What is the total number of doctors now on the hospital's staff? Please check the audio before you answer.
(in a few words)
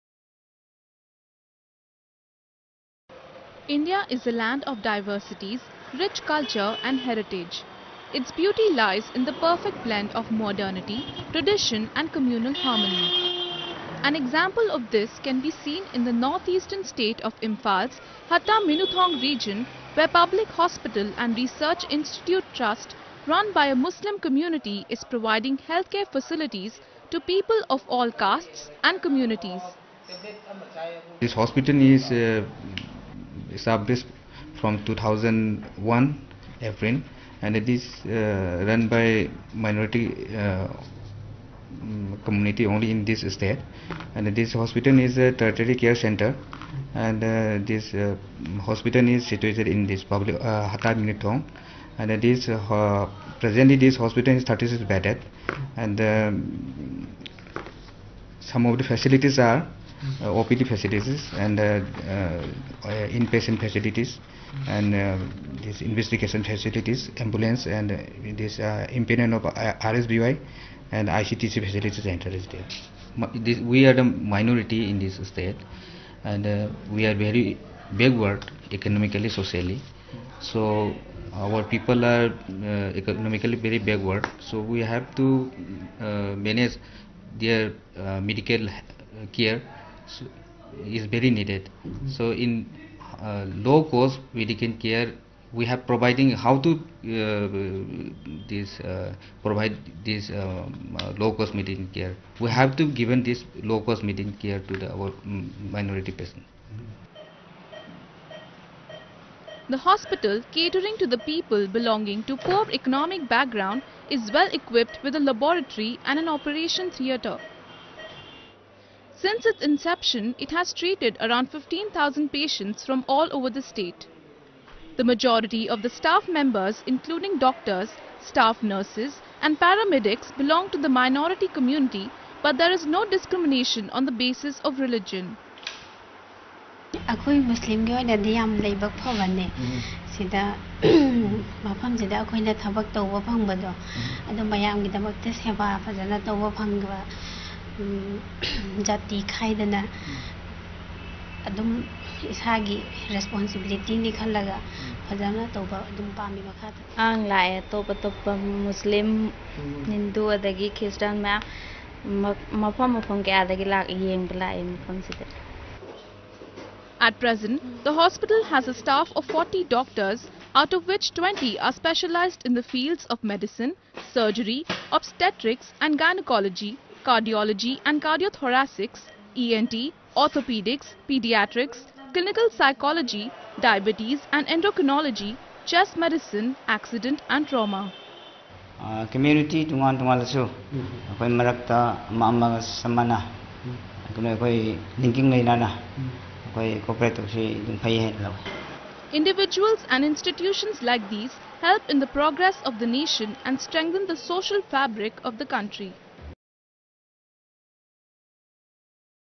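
40.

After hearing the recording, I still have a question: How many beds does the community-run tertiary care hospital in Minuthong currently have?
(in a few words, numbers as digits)
36.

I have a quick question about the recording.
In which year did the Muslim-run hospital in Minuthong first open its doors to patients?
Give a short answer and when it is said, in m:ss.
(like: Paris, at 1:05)
2001, at 0:34.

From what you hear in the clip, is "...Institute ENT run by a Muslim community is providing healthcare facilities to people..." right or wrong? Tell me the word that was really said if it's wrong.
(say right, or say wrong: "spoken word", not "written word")
wrong: "Trust", not "ENT".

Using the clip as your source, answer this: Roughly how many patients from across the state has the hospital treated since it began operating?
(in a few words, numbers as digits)
15,000.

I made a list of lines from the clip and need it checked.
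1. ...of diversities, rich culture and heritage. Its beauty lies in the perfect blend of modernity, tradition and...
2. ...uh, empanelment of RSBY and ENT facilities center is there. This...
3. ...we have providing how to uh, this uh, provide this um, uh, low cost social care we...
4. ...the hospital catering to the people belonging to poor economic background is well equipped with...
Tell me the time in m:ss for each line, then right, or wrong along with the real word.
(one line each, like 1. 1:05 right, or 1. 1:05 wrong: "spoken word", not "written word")
1. 0:04 right
2. 1:08 wrong: "ICTC", not "ENT"
3. 1:35 wrong: "medical", not "social"
4. 1:49 right.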